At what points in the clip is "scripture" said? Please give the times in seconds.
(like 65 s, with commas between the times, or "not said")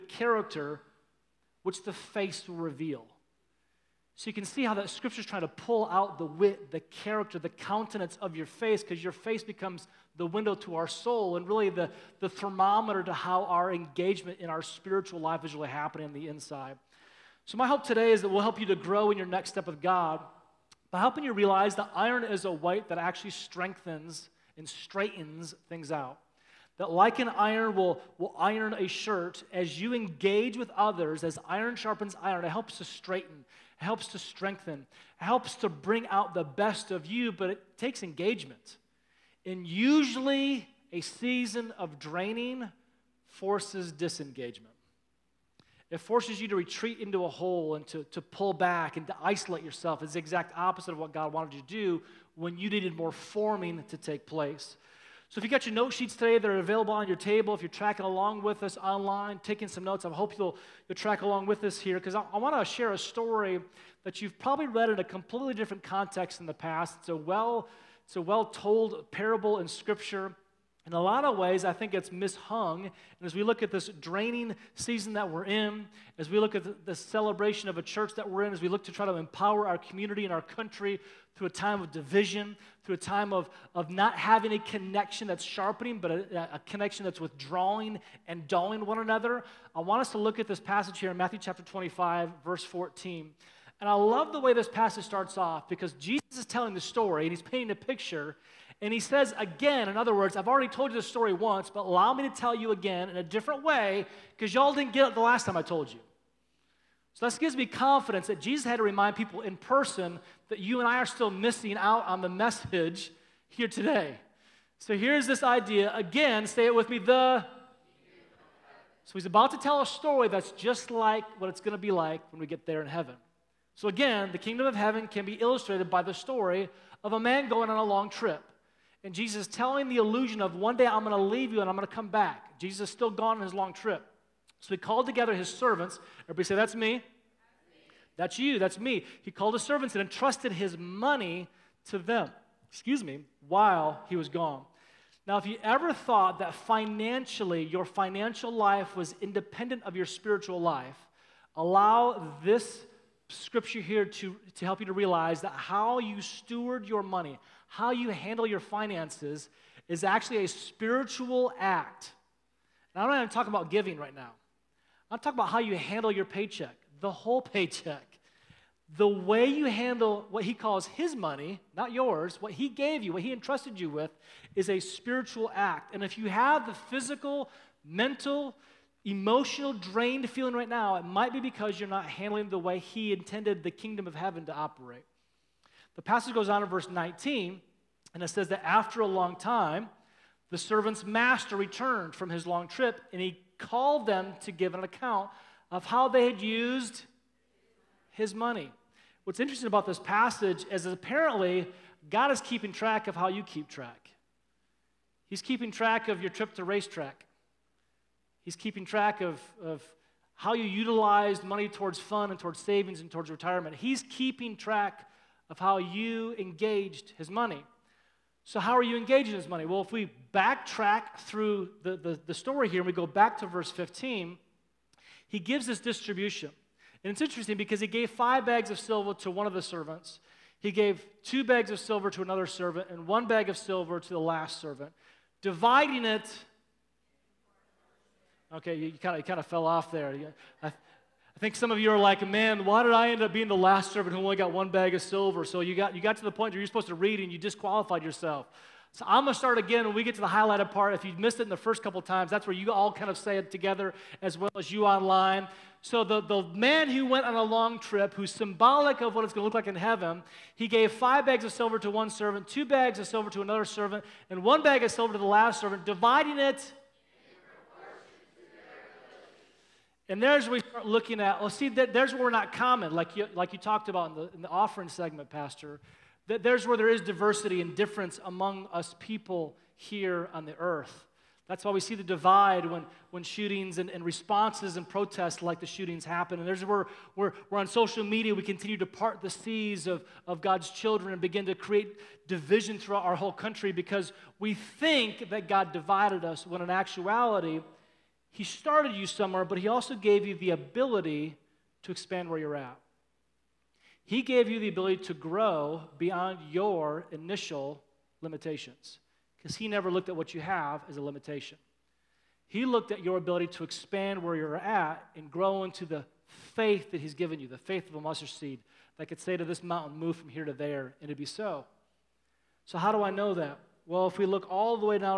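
4 s, 69 s, 153 s.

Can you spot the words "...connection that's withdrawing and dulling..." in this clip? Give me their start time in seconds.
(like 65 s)
86 s.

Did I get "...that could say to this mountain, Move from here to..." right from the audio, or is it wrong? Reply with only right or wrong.
right.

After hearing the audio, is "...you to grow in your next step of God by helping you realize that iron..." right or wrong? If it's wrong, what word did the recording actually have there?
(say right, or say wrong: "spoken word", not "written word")
right.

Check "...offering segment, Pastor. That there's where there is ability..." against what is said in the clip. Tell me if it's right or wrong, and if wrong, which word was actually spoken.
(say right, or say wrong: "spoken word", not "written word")
wrong: "diversity", not "ability".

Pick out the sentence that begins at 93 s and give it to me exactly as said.
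And I love the way this passage starts off because Jesus is telling the story and he's painting a picture.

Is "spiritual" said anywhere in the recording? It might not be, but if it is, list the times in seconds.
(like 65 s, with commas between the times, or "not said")
14 s, 150 s, 160 s, 174 s.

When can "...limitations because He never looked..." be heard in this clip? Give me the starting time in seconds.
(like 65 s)
308 s.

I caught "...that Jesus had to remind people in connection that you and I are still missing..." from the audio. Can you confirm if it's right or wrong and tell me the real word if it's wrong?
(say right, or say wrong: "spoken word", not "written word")
wrong: "person", not "connection".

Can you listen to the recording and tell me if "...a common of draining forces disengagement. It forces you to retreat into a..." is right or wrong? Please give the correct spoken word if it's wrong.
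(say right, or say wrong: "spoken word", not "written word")
wrong: "season", not "common".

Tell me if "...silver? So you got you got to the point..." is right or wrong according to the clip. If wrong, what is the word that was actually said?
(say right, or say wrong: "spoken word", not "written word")
right.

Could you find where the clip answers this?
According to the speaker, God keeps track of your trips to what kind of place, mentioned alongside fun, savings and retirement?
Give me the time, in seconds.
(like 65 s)
206 s.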